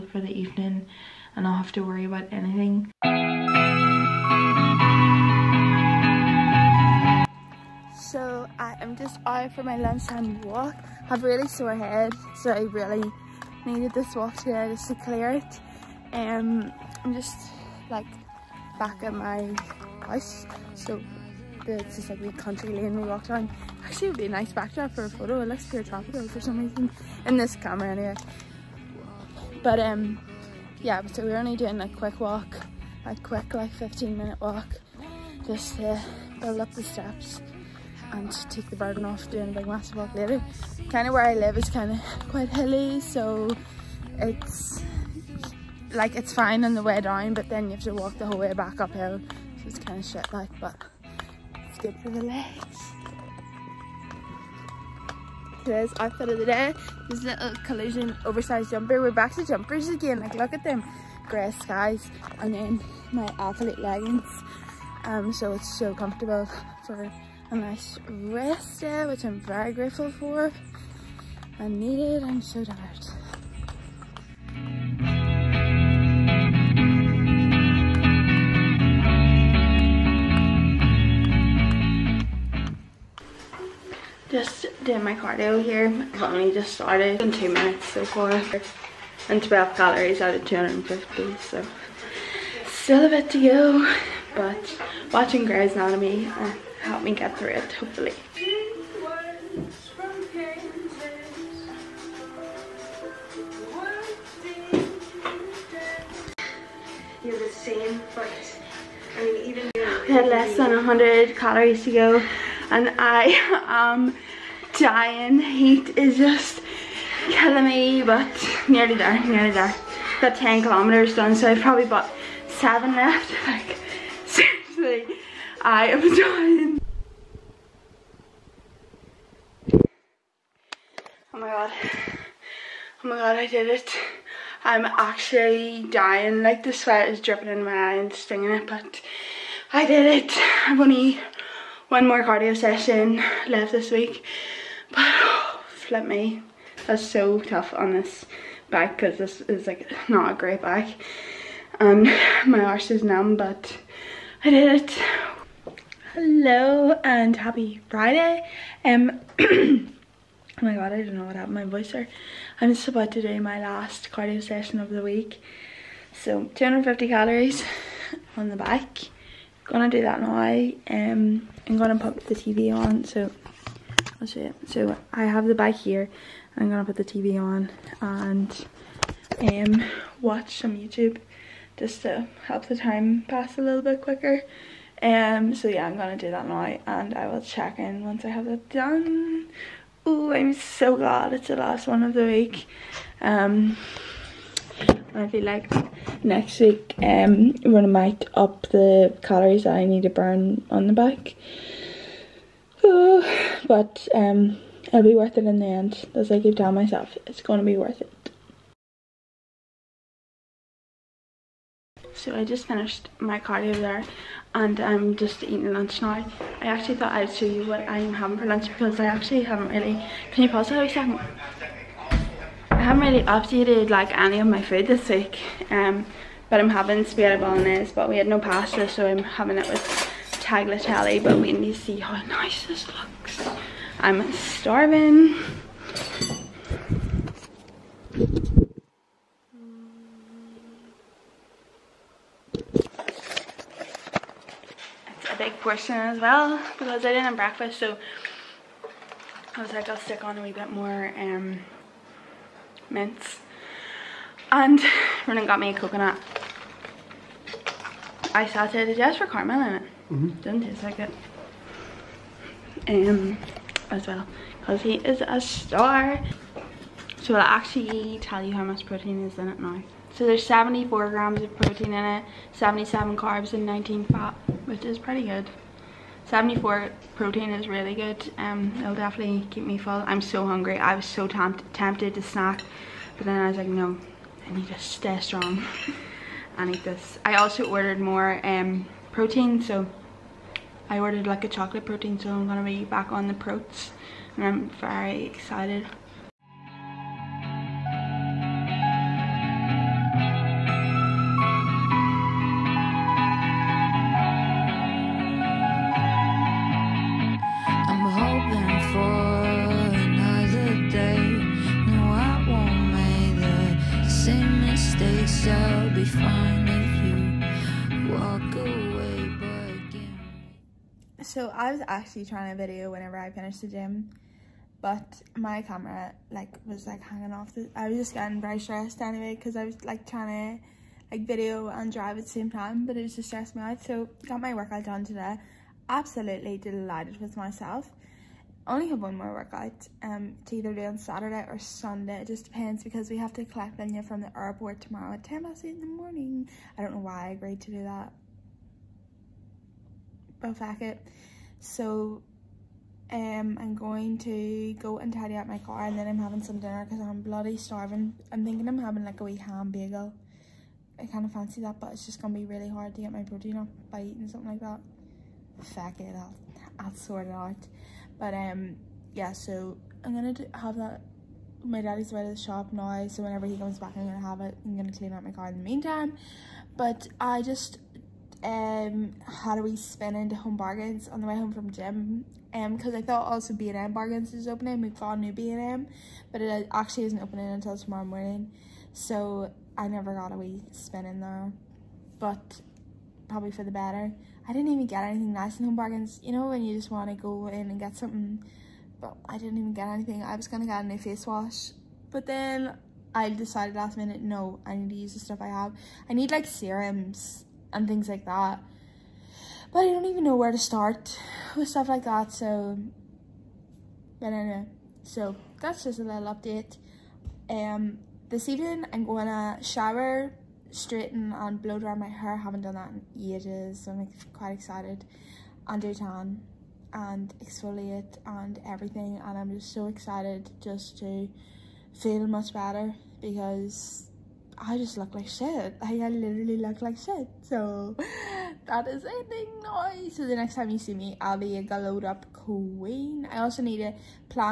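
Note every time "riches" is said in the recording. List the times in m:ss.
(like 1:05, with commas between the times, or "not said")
not said.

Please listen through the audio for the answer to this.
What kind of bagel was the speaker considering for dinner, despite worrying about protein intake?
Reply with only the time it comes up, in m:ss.
5:59.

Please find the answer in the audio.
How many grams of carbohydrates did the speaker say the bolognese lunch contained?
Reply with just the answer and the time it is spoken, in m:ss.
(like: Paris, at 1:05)
77, at 4:32.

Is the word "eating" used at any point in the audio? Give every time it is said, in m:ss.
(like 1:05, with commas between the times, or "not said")
3:35, 6:04.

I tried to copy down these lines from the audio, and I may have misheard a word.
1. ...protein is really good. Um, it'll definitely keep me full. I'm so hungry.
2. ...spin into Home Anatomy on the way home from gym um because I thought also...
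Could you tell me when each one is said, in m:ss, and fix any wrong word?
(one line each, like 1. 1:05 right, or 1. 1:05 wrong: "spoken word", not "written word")
1. 4:37 right
2. 6:19 wrong: "Bargains", not "Anatomy".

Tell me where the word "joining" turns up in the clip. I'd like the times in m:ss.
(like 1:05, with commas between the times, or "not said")
not said.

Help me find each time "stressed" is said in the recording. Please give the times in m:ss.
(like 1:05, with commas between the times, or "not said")
5:28, 5:33.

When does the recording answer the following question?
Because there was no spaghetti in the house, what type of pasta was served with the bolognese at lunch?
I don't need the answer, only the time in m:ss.
3:50.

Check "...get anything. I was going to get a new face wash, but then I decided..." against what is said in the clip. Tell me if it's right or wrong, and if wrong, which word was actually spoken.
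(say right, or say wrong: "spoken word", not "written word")
right.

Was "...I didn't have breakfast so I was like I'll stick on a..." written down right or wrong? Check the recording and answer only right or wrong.
right.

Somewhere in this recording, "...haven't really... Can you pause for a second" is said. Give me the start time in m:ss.
3:39.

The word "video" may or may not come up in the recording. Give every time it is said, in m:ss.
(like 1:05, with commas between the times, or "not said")
5:22, 5:31.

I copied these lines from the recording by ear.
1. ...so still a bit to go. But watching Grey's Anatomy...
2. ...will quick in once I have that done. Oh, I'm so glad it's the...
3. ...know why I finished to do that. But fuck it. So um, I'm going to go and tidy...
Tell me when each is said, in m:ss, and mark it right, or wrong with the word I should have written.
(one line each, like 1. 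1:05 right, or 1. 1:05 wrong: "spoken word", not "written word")
1. 1:31 right
2. 3:07 wrong: "check", not "quick"
3. 5:46 wrong: "agreed", not "finished".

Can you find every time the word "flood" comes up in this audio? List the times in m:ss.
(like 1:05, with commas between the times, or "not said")
not said.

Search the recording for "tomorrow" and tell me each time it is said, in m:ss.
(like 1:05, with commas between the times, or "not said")
5:44, 6:27.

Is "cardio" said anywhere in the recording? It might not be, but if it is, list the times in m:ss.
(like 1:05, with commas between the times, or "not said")
1:25, 2:22, 2:44, 3:33.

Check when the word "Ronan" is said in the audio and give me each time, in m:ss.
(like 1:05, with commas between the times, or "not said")
4:15.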